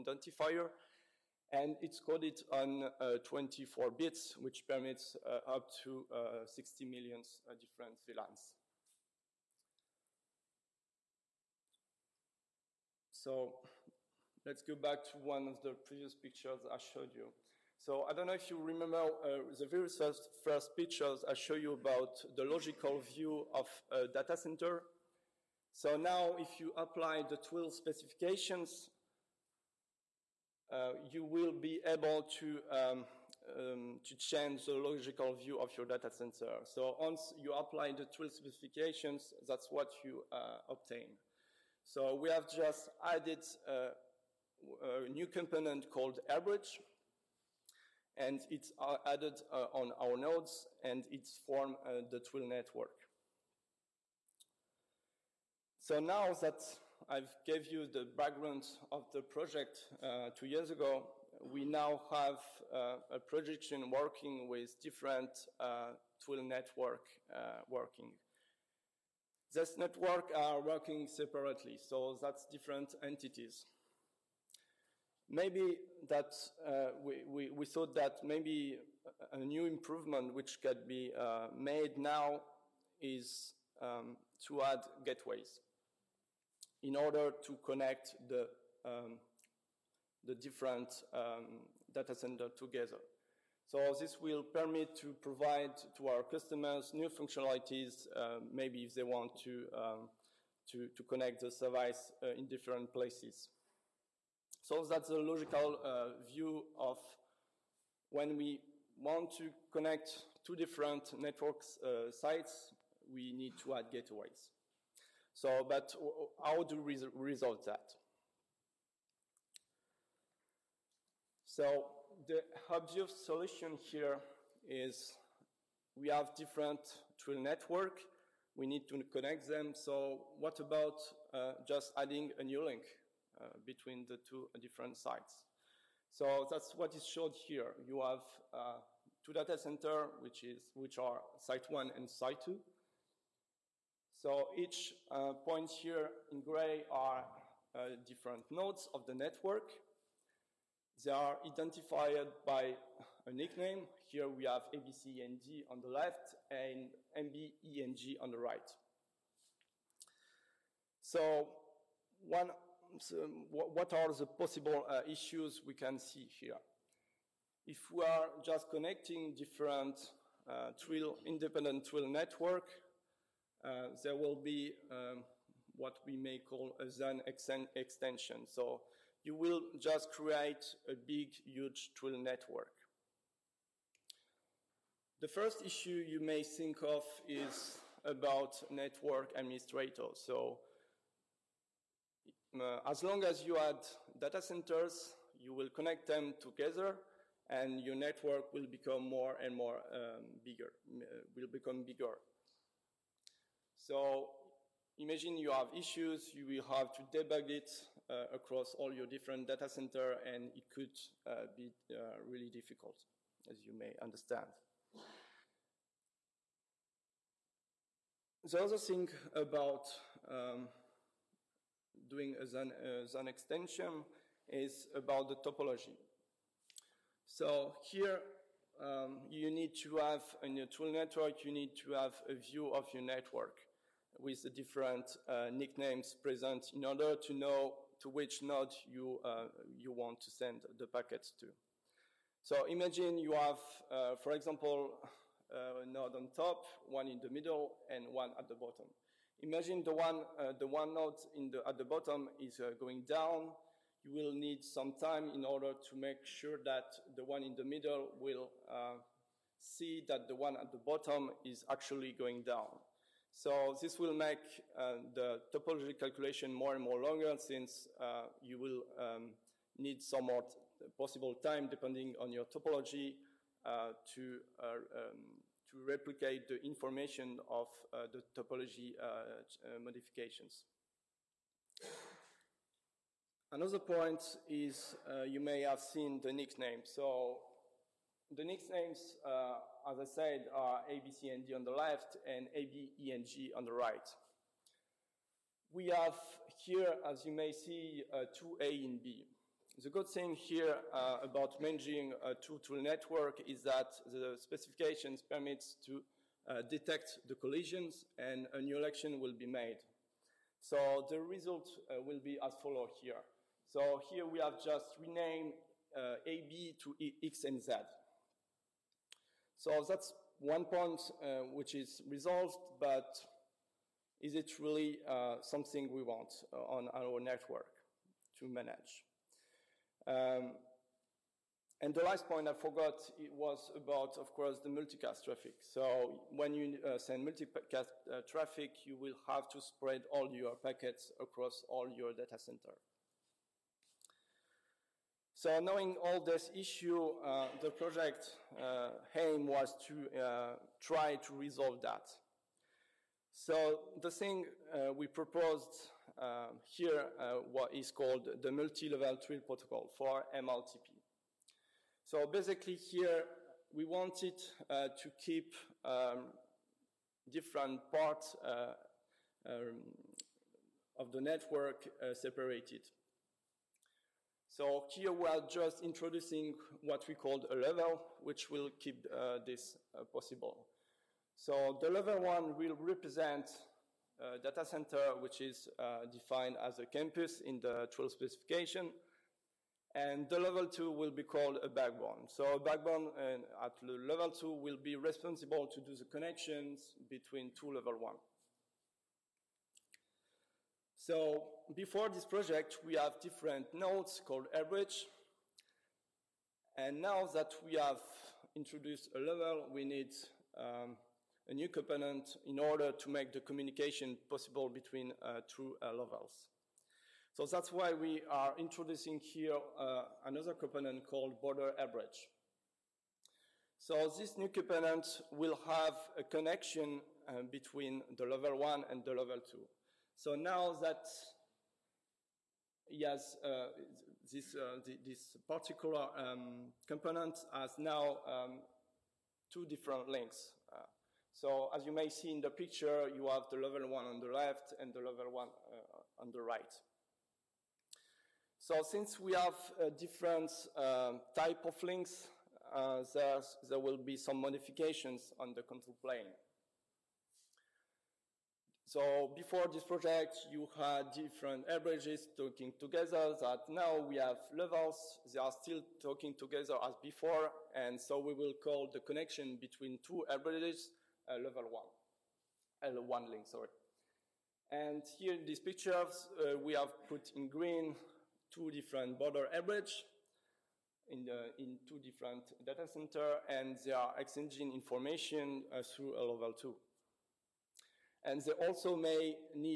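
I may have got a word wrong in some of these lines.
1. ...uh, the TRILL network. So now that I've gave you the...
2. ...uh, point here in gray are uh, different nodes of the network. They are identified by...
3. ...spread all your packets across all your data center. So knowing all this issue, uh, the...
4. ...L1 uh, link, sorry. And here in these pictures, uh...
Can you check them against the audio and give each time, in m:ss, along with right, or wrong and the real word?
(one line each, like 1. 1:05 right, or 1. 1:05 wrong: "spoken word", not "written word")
1. 0:51 right
2. 2:25 right
3. 5:39 right
4. 7:52 right.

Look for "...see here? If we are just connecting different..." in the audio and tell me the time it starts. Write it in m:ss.
2:45.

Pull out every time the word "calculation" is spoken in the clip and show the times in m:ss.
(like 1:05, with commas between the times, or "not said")
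4:25.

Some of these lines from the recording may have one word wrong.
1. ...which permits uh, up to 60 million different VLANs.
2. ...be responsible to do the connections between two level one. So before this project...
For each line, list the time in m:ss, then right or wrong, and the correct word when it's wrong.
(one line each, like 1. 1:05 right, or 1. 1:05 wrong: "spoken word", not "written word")
1. 0:04 right
2. 6:34 right.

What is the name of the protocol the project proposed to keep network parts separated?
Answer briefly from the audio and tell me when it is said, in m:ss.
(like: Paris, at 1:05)
Multi-level TRILL protocol, at 5:58.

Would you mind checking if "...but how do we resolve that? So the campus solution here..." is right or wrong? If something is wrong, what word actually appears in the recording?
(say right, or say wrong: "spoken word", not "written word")
wrong: "obvious", not "campus".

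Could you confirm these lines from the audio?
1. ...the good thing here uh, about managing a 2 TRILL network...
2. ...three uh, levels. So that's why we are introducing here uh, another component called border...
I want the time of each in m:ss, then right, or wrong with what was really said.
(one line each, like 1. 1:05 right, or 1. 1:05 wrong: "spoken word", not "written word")
1. 4:59 right
2. 6:55 wrong: "two", not "three".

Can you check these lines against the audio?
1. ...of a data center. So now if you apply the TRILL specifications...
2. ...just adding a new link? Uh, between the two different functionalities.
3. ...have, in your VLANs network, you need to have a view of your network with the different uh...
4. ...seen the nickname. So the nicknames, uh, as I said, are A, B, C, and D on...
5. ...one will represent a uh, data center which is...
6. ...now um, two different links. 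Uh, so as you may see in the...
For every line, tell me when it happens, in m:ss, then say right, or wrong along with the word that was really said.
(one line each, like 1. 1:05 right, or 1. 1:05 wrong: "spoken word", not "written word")
1. 0:23 right
2. 2:11 wrong: "sites", not "functionalities"
3. 3:49 wrong: "TRILL", not "VLANs"
4. 4:45 right
5. 6:22 right
6. 7:17 right.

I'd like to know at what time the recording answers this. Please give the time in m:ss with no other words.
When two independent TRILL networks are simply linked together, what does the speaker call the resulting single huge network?
2:56.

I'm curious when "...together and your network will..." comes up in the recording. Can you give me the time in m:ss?
3:16.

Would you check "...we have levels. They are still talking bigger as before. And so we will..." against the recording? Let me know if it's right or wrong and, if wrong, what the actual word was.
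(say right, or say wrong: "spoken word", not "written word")
wrong: "together", not "bigger".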